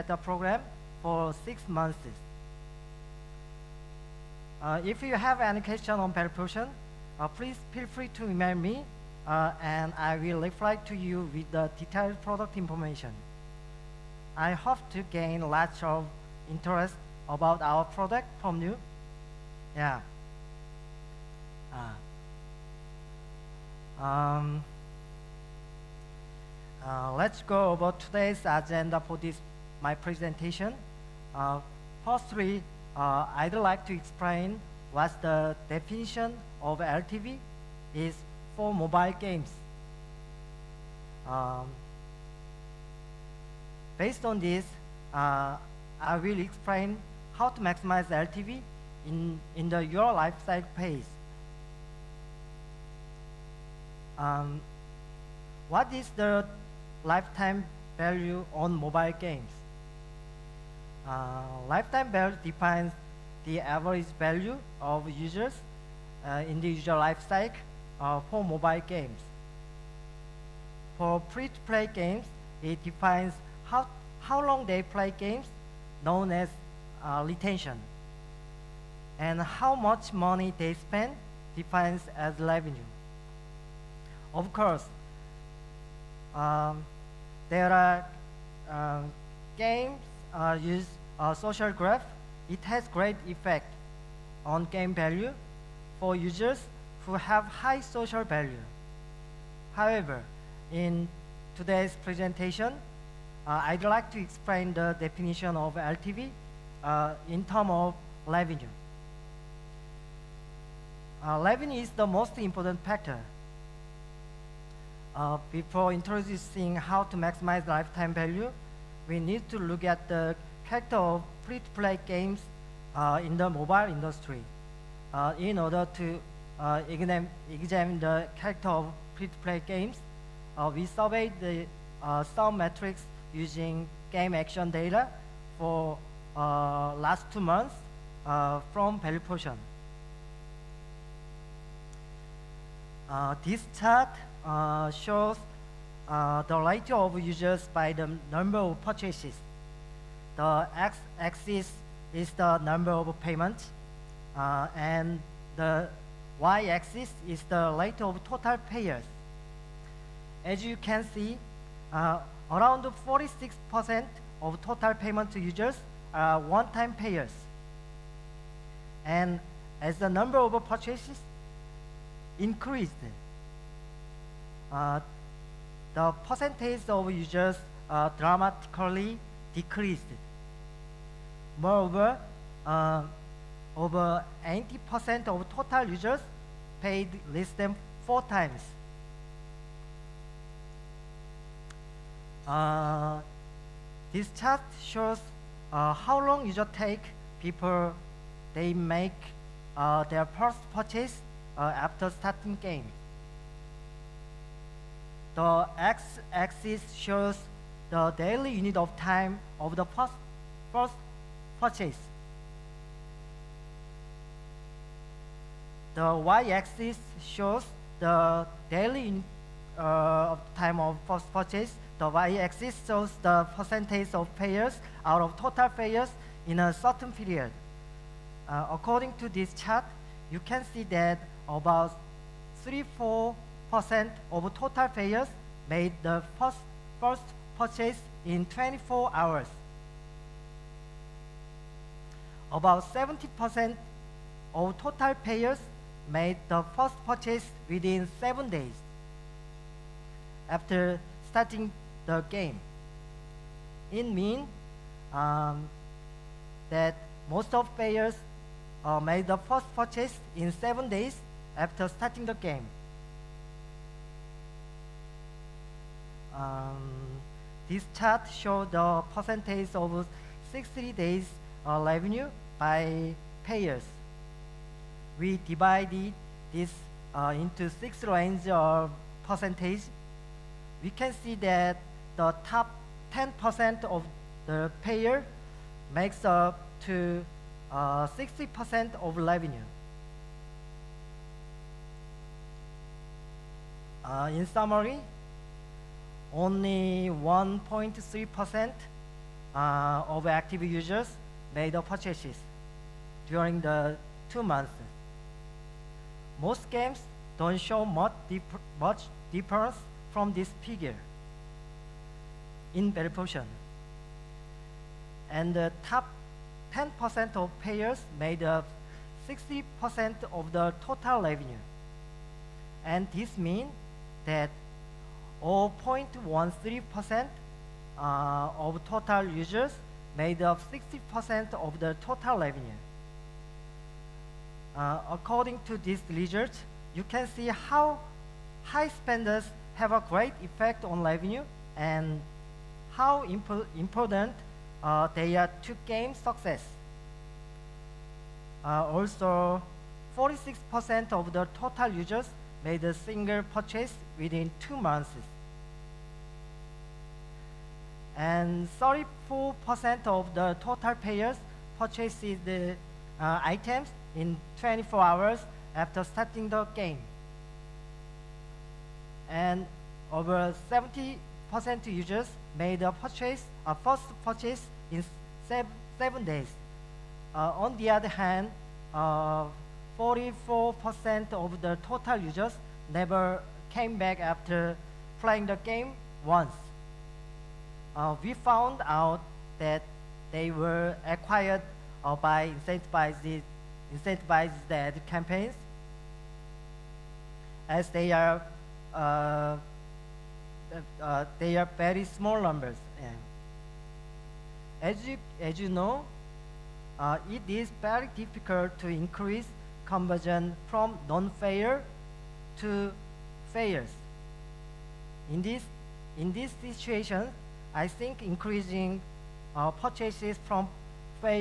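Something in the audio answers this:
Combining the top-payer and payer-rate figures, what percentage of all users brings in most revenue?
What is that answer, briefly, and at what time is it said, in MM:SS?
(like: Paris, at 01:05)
0.13%, at 05:25.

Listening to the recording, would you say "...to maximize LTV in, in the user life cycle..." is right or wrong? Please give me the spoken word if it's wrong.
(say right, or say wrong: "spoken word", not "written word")
right.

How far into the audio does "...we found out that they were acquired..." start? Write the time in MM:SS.
06:28.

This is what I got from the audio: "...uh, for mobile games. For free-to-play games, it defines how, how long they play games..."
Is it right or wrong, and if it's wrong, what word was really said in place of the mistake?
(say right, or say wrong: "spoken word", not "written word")
right.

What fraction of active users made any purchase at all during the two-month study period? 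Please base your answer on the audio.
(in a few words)
1.3%.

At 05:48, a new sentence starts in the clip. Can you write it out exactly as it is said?
Uh, also, 46% of the total users made a single purchase within two months.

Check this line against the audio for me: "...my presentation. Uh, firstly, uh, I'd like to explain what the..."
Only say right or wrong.
right.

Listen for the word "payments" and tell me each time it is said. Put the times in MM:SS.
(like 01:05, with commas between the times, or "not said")
02:33, 02:44.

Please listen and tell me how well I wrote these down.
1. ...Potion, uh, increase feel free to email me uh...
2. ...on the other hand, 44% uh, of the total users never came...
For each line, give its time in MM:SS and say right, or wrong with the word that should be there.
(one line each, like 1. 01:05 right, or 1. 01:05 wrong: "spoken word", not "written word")
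1. 00:06 wrong: "please", not "increase"
2. 06:17 right.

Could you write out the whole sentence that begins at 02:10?
Uh, we surveyed the uh, some metrics using game action data for uh, last two months uh, from Value Potion.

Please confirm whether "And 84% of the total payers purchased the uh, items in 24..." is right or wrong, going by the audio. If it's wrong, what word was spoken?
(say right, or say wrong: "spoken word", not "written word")
wrong: "34", not "84".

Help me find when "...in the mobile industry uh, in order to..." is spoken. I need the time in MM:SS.
02:03.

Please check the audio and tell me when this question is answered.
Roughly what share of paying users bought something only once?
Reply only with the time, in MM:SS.
02:42.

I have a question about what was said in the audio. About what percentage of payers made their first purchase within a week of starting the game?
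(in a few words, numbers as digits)
70%.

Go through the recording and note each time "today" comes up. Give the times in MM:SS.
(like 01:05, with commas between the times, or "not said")
00:27, 01:41.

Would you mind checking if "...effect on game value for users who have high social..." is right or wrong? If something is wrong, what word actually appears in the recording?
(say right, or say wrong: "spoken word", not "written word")
right.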